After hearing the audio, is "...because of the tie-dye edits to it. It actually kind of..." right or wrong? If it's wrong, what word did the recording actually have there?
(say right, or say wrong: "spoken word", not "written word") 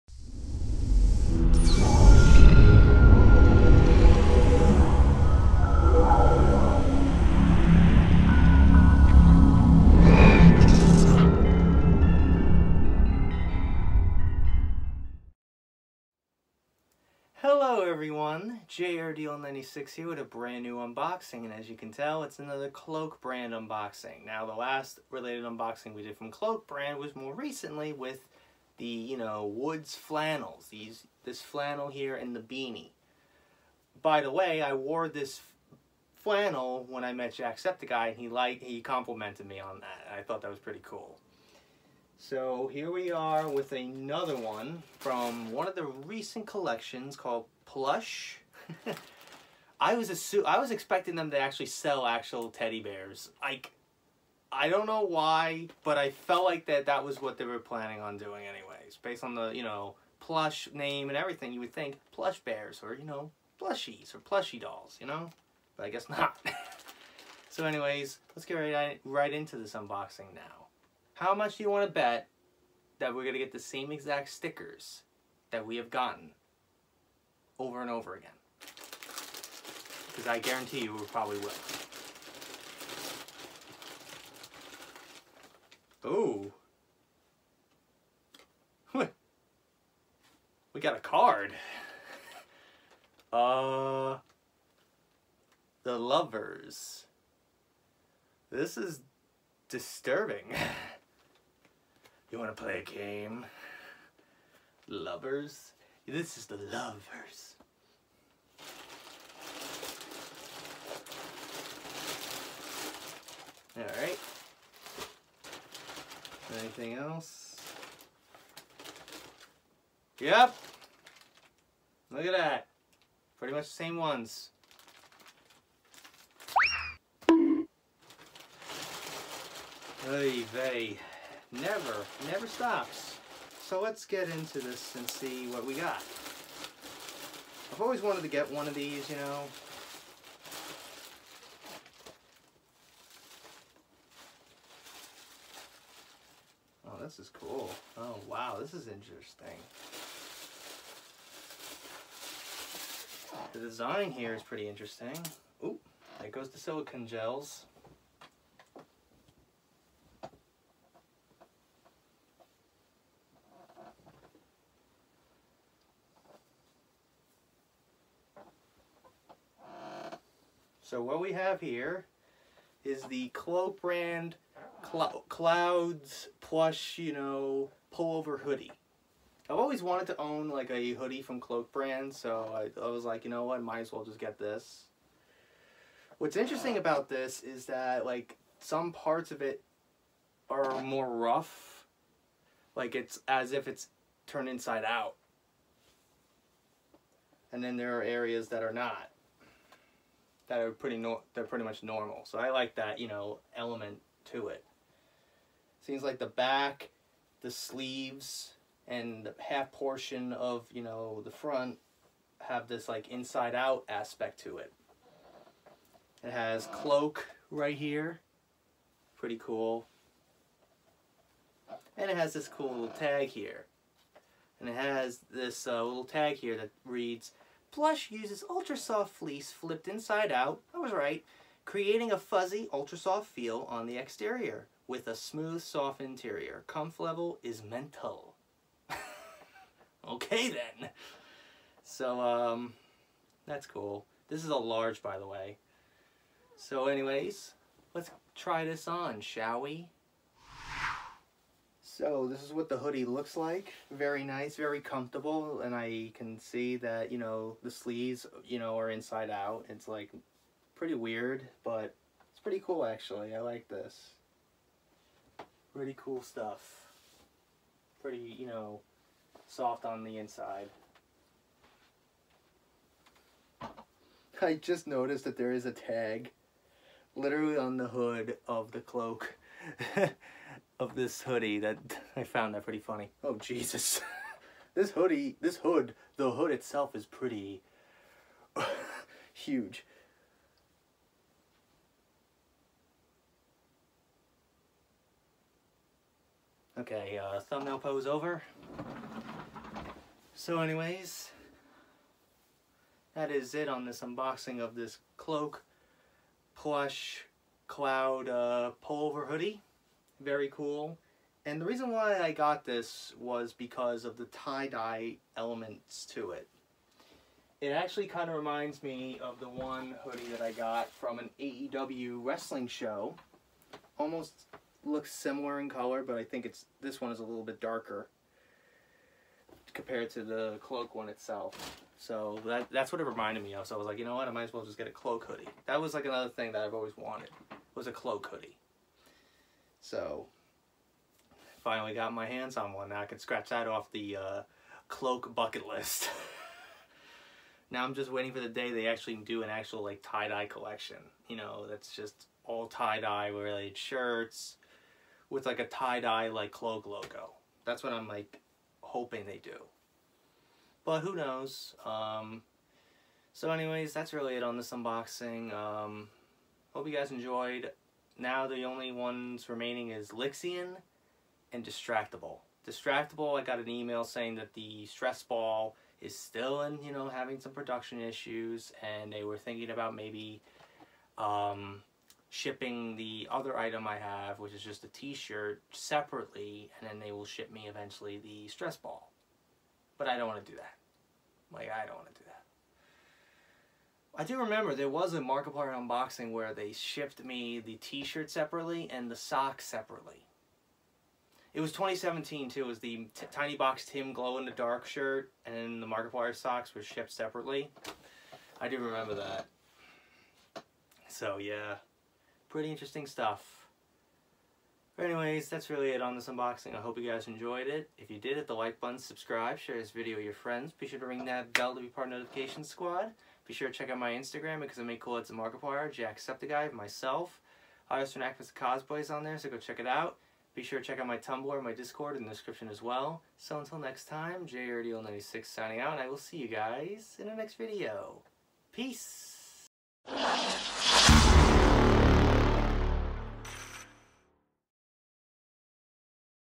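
wrong: "elements", not "edits".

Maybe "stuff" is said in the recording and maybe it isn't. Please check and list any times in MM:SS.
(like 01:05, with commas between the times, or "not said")
04:26, 06:53.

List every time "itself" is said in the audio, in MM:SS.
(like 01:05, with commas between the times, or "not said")
04:46, 05:31.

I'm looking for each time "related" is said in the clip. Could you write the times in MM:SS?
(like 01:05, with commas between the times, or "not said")
00:25, 05:53.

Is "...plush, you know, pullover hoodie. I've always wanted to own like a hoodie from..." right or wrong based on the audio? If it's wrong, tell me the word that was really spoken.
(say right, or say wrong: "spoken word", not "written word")
right.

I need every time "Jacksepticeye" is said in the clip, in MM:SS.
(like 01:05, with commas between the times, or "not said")
00:37, 07:05.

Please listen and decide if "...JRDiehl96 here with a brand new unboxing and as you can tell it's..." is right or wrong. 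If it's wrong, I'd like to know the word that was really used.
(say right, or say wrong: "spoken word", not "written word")
right.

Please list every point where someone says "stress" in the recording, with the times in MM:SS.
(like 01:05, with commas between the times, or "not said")
06:14, 06:28.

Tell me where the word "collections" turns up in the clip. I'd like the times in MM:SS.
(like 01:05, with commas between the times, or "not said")
00:46, 05:50.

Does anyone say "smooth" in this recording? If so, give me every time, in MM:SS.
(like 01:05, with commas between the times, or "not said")
03:55.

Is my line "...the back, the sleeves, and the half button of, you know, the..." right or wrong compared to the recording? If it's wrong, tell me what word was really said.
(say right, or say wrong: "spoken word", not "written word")
wrong: "portion", not "button".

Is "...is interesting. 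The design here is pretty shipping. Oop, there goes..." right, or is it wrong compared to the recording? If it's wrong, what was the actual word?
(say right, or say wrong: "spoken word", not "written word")
wrong: "interesting", not "shipping".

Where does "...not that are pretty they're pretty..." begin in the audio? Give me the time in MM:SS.
03:18.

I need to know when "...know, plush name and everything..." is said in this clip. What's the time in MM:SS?
00:59.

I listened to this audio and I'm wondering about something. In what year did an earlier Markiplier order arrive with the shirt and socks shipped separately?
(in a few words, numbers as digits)
2017.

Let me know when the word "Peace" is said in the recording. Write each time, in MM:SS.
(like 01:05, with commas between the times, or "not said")
07:18.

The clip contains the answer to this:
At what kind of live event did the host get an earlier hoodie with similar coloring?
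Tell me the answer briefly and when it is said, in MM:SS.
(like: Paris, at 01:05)
AEW wrestling show, at 05:21.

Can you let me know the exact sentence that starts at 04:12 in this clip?
So this is what the hoodie looks like.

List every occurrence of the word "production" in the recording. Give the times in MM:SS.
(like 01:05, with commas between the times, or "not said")
06:17.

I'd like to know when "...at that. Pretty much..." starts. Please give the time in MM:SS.
02:02.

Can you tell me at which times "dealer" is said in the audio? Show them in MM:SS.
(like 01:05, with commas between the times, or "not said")
not said.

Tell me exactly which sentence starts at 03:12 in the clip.
Like it's as if it's turned inside out.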